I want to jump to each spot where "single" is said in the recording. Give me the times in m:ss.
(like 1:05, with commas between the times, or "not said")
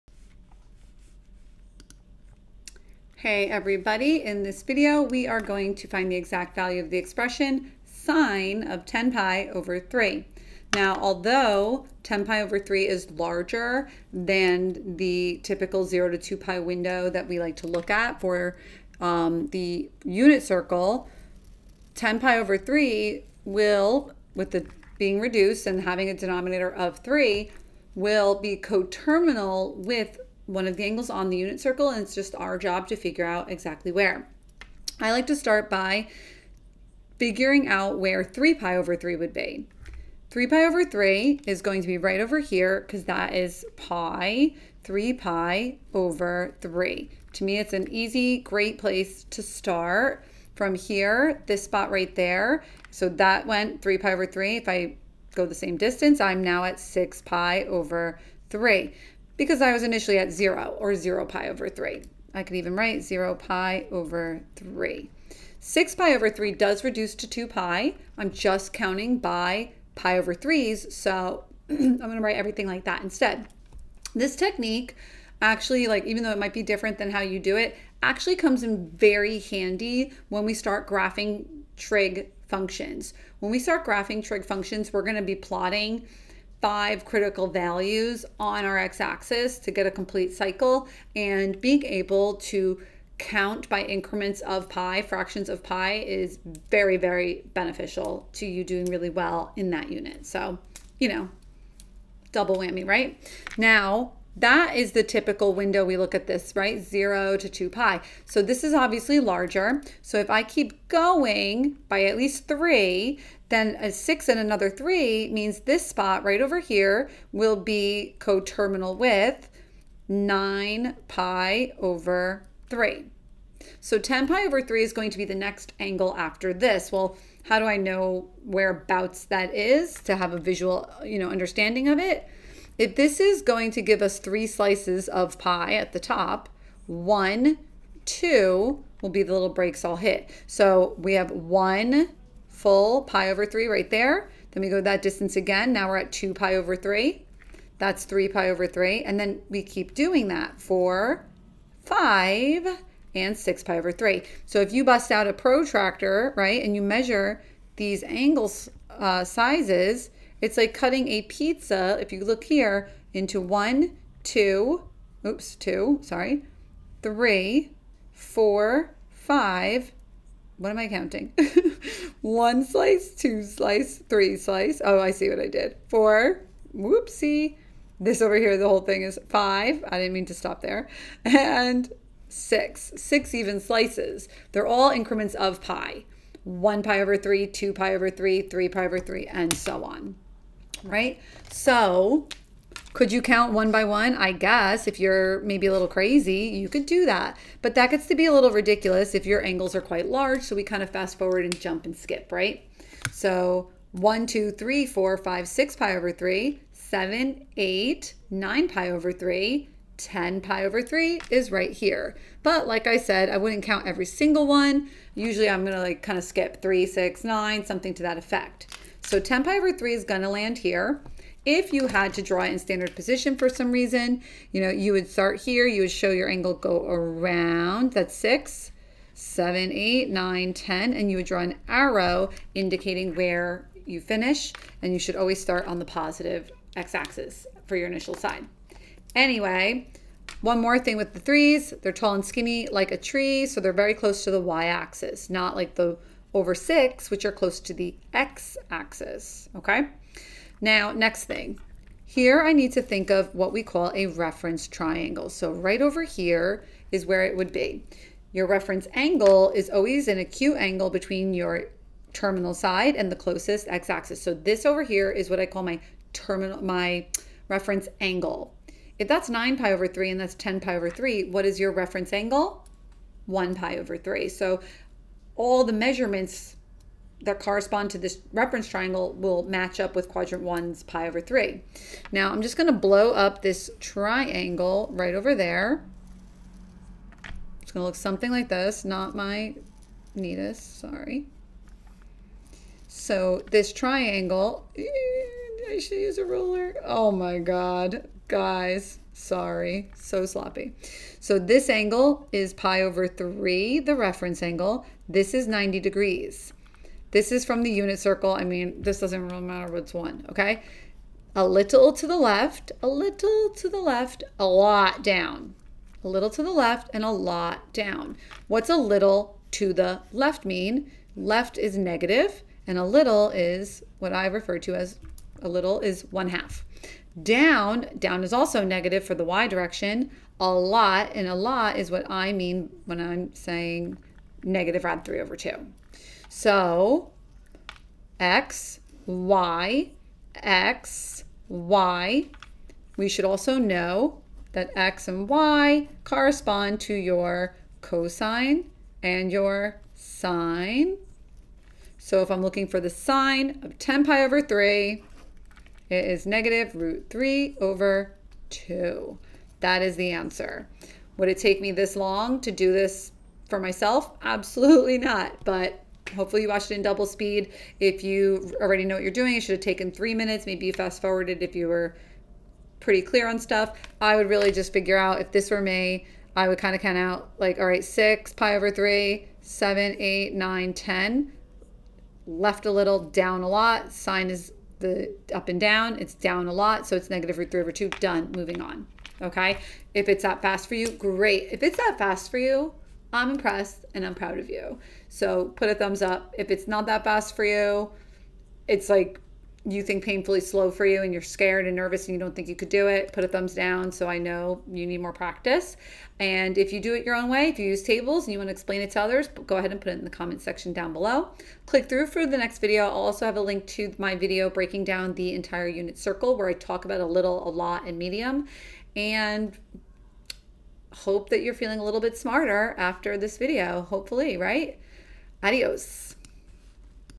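3:34.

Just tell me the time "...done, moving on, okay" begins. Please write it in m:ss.
6:28.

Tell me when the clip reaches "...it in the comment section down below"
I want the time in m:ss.
6:49.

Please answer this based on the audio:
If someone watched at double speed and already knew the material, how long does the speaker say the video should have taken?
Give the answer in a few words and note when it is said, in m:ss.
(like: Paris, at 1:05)
3 minutes, at 6:09.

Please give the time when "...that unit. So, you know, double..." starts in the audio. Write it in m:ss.
1:39.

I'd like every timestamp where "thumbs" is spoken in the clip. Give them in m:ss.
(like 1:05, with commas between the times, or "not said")
6:35, 6:43.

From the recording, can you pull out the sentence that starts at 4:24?
So this over here is what I call my terminal, my reference angle.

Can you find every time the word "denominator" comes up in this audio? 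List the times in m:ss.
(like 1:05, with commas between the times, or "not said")
0:26.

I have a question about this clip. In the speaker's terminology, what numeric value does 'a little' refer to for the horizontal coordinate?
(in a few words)
one half.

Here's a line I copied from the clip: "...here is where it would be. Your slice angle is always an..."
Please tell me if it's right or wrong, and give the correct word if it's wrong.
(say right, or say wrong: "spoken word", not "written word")
wrong: "reference", not "slice".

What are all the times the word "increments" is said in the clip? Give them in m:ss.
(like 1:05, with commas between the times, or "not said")
1:33, 3:04.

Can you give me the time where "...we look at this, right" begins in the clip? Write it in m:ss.
1:45.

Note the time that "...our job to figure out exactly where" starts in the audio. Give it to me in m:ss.
0:32.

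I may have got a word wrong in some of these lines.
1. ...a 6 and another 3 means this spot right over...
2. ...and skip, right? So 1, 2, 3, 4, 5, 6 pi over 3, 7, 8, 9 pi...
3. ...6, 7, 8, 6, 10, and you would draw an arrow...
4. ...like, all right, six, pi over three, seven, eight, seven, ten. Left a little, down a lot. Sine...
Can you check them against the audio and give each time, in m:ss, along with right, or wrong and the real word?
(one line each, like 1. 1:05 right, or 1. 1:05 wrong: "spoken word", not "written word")
1. 1:53 right
2. 3:21 right
3. 3:48 wrong: "9", not "6"
4. 6:17 wrong: "nine", not "seven".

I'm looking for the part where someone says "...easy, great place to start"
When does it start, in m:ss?
0:47.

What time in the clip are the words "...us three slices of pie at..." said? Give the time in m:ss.
2:14.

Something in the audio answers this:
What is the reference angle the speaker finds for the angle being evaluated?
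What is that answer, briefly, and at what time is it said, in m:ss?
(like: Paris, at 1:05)
pi over 3, at 4:33.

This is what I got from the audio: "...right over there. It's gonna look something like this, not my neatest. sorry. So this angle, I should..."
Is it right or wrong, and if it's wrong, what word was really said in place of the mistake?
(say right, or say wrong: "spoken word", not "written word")
wrong: "triangle", not "angle".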